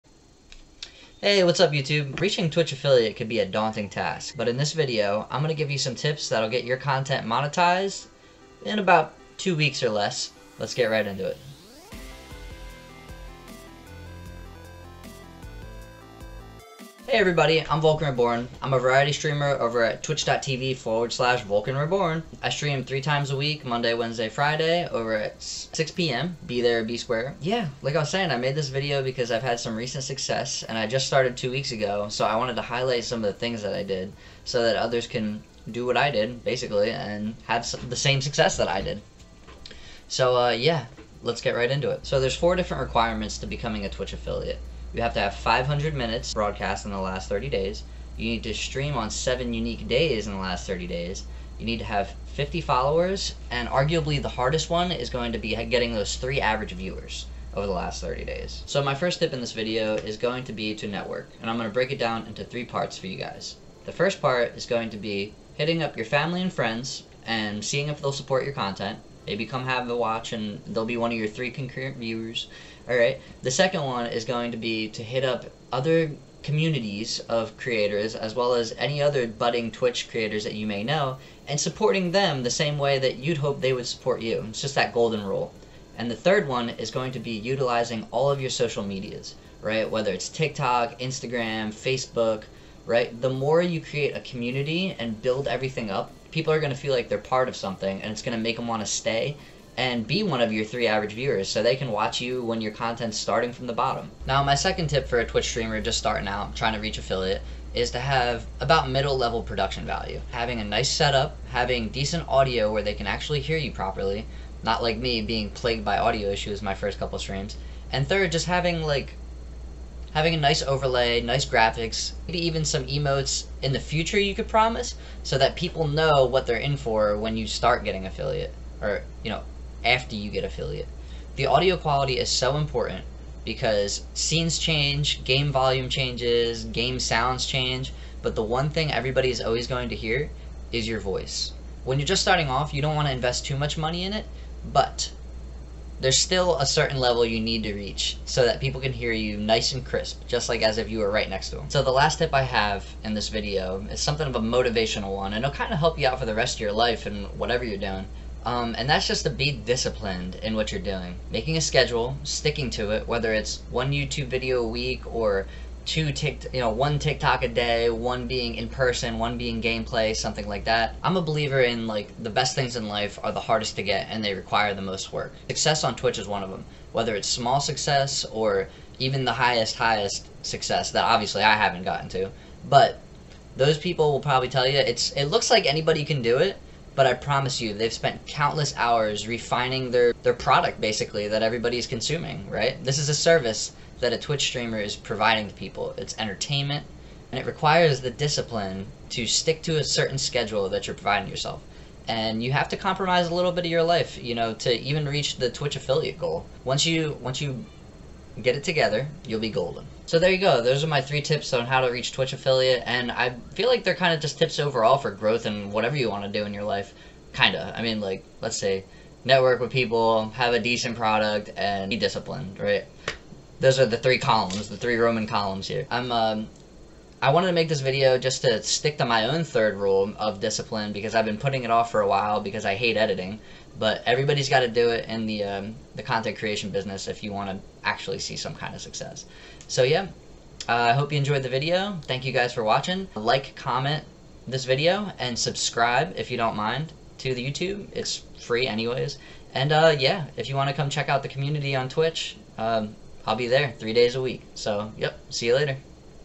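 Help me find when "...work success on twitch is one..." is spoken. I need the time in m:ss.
2:55.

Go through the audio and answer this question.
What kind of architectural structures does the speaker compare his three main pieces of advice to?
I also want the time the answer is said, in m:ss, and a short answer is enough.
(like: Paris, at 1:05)
Roman columns, at 3:44.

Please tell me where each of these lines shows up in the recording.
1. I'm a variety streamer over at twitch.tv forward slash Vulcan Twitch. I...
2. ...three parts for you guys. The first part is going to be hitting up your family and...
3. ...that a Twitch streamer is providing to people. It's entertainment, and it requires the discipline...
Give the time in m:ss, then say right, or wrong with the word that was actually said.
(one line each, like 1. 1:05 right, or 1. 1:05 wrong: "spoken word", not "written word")
1. 0:18 wrong: "Reborn", not "Twitch"
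2. 1:02 right
3. 3:14 right.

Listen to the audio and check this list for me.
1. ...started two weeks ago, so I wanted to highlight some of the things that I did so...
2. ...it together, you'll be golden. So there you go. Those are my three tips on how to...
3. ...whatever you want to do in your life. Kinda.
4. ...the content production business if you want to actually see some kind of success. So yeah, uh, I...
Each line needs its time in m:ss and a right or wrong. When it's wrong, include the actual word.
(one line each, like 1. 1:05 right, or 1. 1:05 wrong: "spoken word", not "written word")
1. 0:31 right
2. 3:28 right
3. 3:35 right
4. 3:55 wrong: "creation", not "production".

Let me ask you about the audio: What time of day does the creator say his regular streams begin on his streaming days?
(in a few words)
6 p.m.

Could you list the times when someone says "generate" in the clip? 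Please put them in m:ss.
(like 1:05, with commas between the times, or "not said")
not said.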